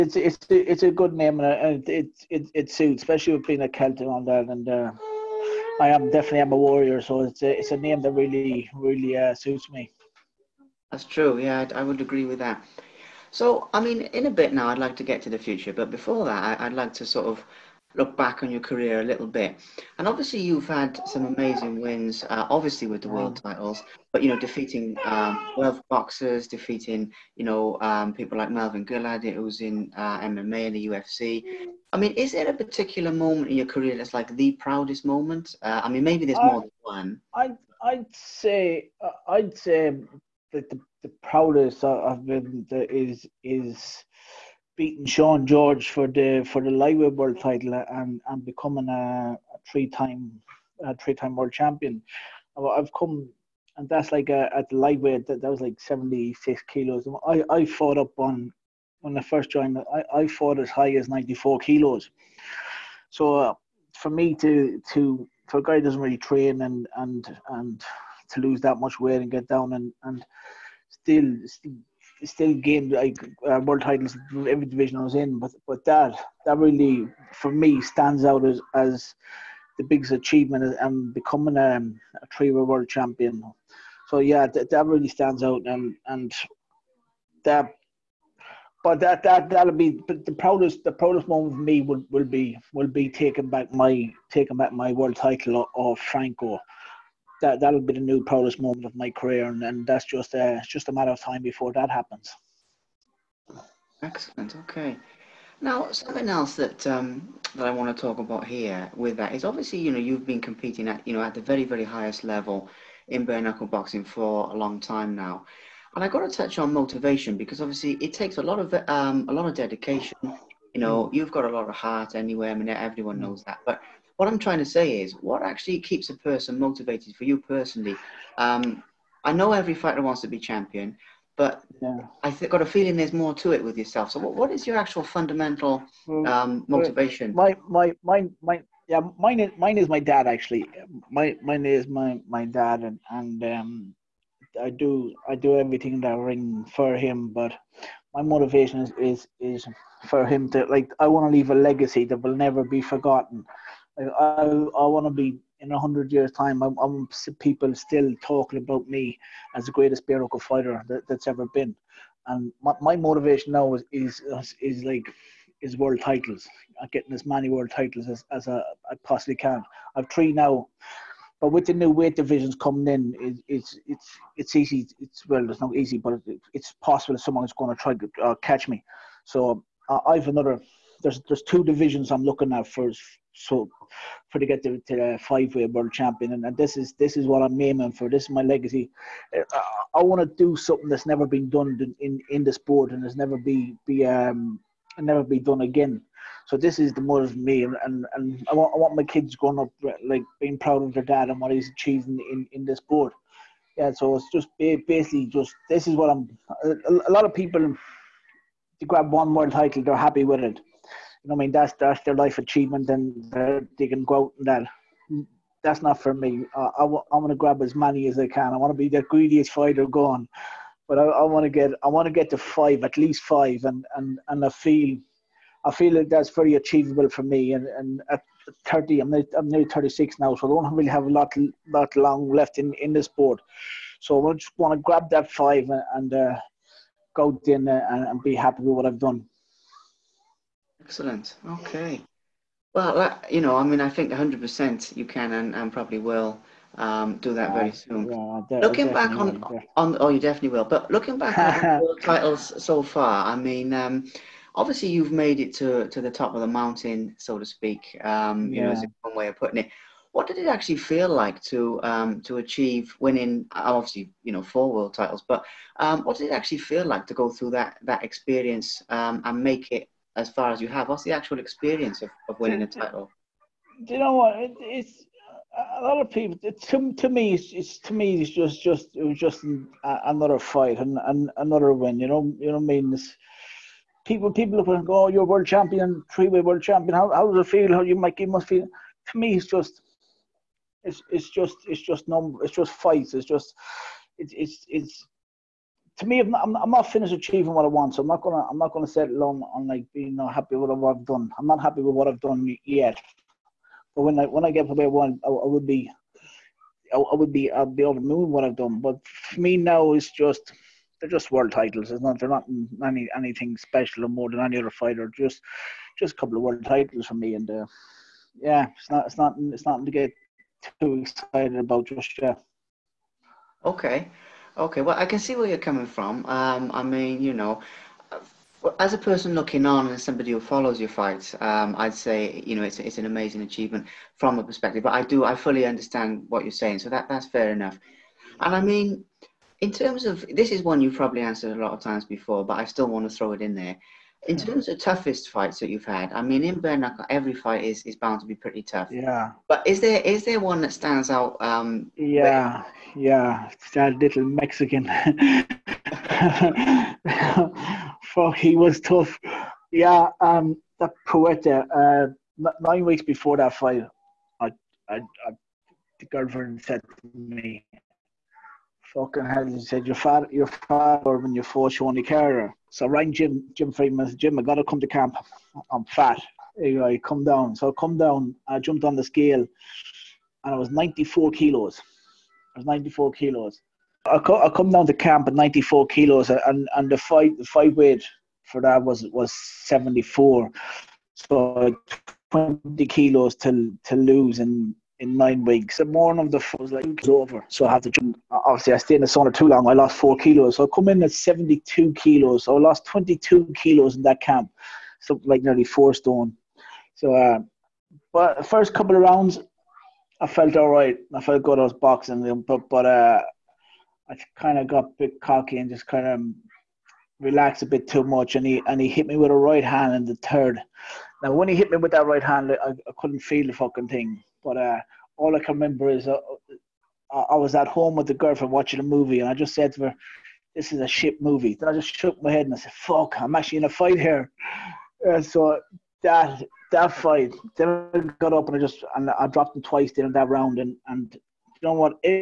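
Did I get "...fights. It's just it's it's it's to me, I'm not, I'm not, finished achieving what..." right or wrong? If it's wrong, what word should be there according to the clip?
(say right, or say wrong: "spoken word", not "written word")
right.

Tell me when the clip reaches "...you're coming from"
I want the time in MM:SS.
05:25.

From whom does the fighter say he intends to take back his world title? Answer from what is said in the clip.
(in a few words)
Franco.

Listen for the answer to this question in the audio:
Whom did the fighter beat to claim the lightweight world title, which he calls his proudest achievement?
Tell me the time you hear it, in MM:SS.
00:45.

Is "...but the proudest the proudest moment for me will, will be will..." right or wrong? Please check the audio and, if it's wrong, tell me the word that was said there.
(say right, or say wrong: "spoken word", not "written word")
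right.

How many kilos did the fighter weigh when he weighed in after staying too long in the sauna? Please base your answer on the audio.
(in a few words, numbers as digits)
72.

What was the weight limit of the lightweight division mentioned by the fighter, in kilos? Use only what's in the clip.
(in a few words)
76.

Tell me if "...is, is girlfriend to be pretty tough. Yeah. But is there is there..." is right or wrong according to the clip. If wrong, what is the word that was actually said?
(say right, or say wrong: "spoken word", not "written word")
wrong: "bound", not "girlfriend".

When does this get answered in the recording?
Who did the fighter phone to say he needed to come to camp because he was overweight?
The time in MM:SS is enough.
06:13.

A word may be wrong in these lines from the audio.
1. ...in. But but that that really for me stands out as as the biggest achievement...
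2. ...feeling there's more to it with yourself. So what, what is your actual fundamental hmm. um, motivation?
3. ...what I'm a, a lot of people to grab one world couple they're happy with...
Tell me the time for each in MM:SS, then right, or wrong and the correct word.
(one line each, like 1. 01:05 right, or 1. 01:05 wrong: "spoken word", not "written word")
1. 01:15 right
2. 02:12 right
3. 03:25 wrong: "title", not "couple".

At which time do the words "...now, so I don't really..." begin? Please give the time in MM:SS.
03:50.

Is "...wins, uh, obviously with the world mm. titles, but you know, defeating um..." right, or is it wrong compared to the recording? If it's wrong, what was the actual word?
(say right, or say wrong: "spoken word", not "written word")
right.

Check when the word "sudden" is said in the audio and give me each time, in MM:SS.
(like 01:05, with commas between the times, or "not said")
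not said.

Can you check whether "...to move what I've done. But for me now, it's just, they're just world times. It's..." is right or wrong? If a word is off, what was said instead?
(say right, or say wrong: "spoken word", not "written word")
wrong: "titles", not "times".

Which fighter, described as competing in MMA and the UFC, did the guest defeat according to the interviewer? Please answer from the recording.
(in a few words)
Melvin Guillard.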